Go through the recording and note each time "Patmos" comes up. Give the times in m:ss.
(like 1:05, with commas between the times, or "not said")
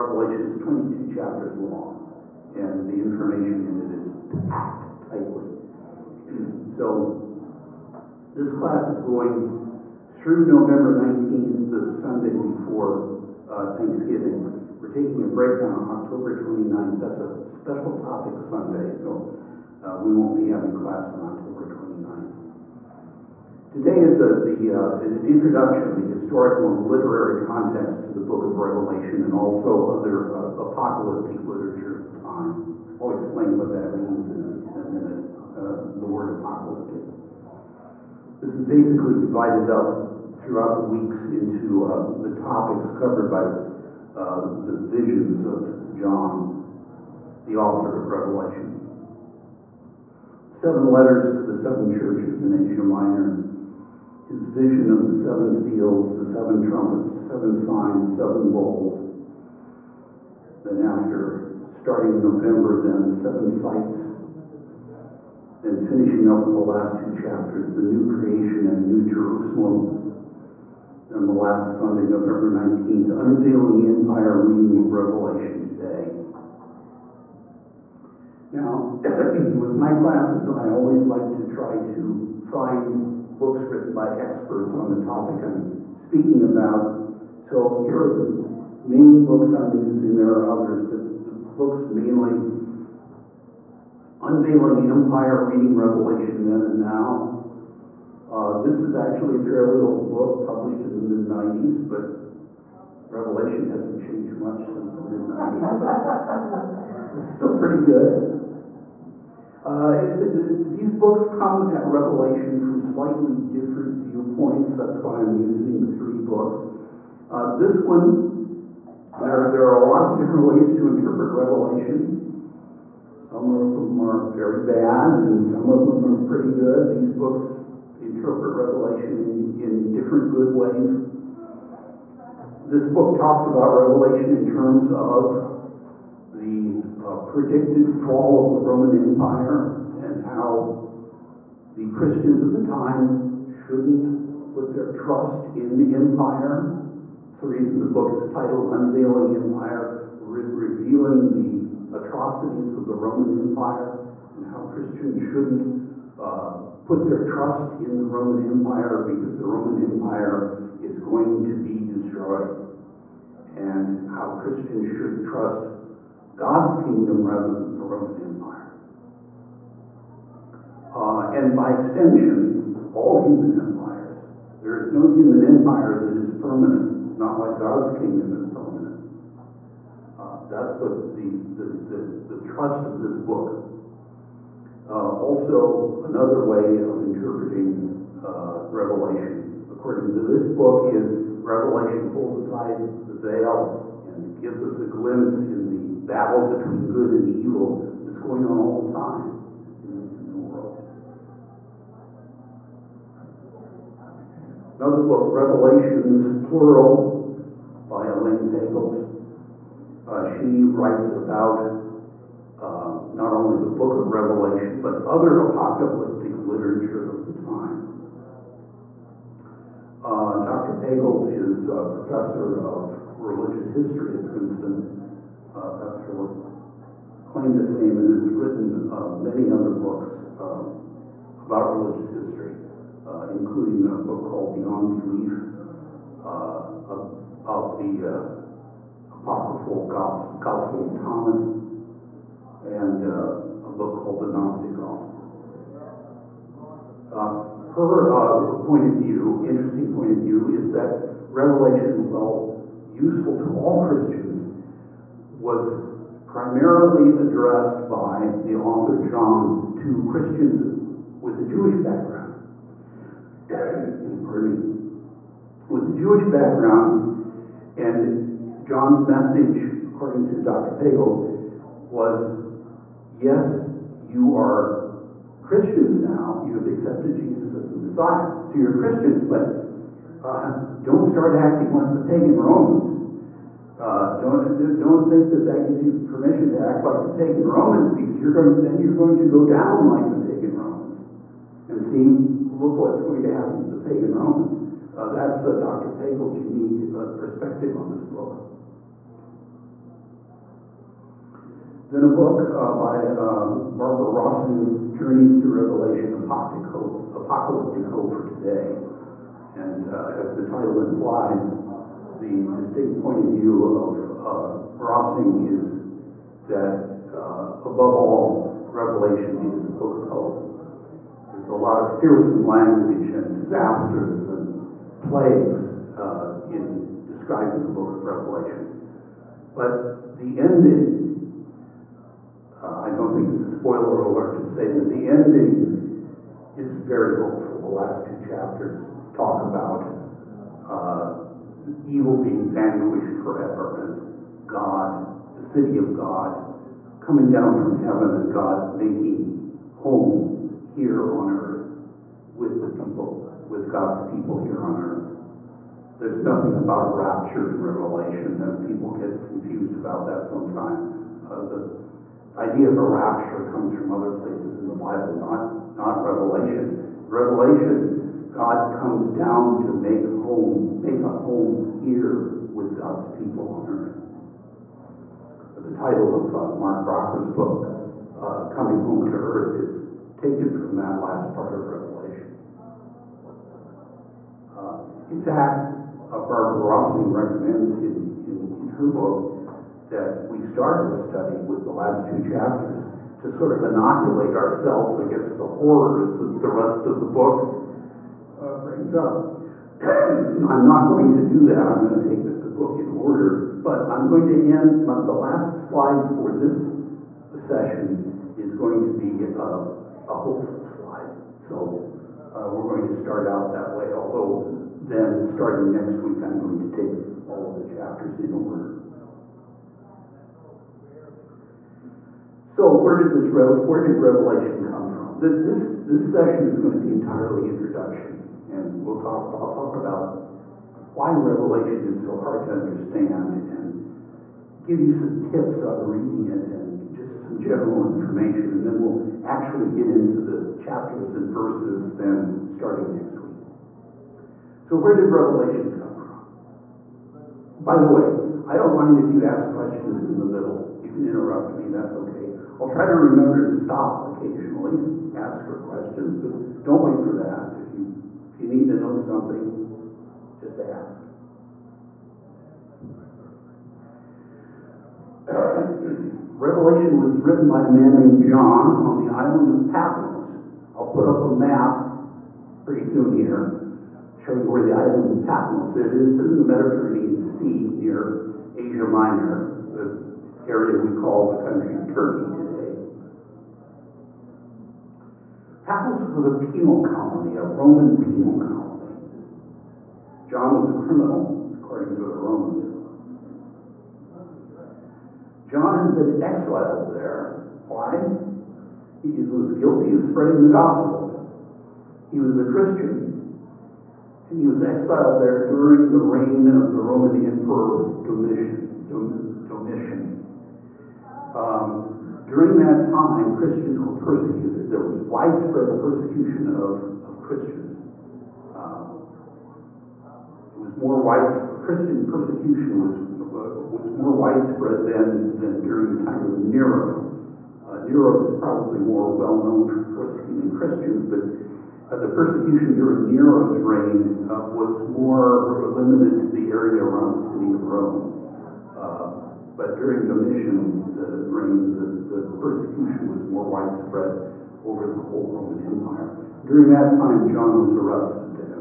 7:49, 7:55.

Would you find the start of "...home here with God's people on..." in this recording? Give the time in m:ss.
6:11.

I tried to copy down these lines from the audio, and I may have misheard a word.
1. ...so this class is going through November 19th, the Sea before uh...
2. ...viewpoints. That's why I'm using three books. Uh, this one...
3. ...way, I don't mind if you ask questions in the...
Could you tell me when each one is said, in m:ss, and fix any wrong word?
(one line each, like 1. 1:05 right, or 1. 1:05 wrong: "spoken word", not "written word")
1. 0:06 wrong: "Sunday", not "Sea"
2. 1:53 right
3. 7:27 right.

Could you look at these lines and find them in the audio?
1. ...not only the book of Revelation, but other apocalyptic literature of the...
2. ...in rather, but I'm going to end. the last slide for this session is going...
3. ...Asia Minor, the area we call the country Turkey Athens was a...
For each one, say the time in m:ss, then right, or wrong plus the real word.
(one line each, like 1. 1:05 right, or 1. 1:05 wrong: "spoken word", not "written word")
1. 3:33 right
2. 6:42 wrong: "order", not "rather"
3. 7:58 right.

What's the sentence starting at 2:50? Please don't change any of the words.
Uh, and by extension, all human empires.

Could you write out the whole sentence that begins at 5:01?
Then a book uh, by uh, Barbara Rossing, Journeys Through Revelation, Apocalyptic Hope, for Today.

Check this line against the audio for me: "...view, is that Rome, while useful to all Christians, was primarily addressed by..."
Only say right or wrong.
wrong.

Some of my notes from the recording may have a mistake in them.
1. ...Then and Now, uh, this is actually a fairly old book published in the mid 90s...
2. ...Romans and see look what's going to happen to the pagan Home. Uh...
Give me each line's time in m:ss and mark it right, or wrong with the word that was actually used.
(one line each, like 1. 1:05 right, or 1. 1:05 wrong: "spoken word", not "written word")
1. 1:36 right
2. 4:50 wrong: "Romans", not "Home".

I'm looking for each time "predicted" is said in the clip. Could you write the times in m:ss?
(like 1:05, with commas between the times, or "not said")
2:17.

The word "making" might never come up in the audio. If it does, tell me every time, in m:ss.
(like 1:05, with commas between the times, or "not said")
5:48.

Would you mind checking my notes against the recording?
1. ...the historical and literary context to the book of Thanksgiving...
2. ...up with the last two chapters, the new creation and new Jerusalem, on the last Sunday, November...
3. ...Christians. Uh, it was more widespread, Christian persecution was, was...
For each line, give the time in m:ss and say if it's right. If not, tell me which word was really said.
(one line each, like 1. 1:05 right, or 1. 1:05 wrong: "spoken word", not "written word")
1. 0:25 wrong: "Revelation", not "Thanksgiving"
2. 1:06 right
3. 8:37 right.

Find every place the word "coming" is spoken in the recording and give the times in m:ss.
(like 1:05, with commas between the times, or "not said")
5:46, 6:18.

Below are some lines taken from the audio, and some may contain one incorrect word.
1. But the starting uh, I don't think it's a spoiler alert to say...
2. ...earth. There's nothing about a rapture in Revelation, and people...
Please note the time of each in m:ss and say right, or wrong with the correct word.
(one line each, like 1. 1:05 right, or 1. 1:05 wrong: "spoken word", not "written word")
1. 5:29 wrong: "ending", not "starting"
2. 5:54 right.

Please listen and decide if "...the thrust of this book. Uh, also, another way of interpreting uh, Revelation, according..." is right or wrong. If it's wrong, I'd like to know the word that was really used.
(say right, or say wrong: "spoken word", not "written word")
right.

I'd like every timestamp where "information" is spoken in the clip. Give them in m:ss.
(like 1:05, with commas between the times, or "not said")
0:03, 7:17.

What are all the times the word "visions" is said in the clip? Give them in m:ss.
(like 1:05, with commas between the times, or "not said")
0:44, 0:54.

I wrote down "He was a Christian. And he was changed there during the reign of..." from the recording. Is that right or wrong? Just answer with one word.
wrong.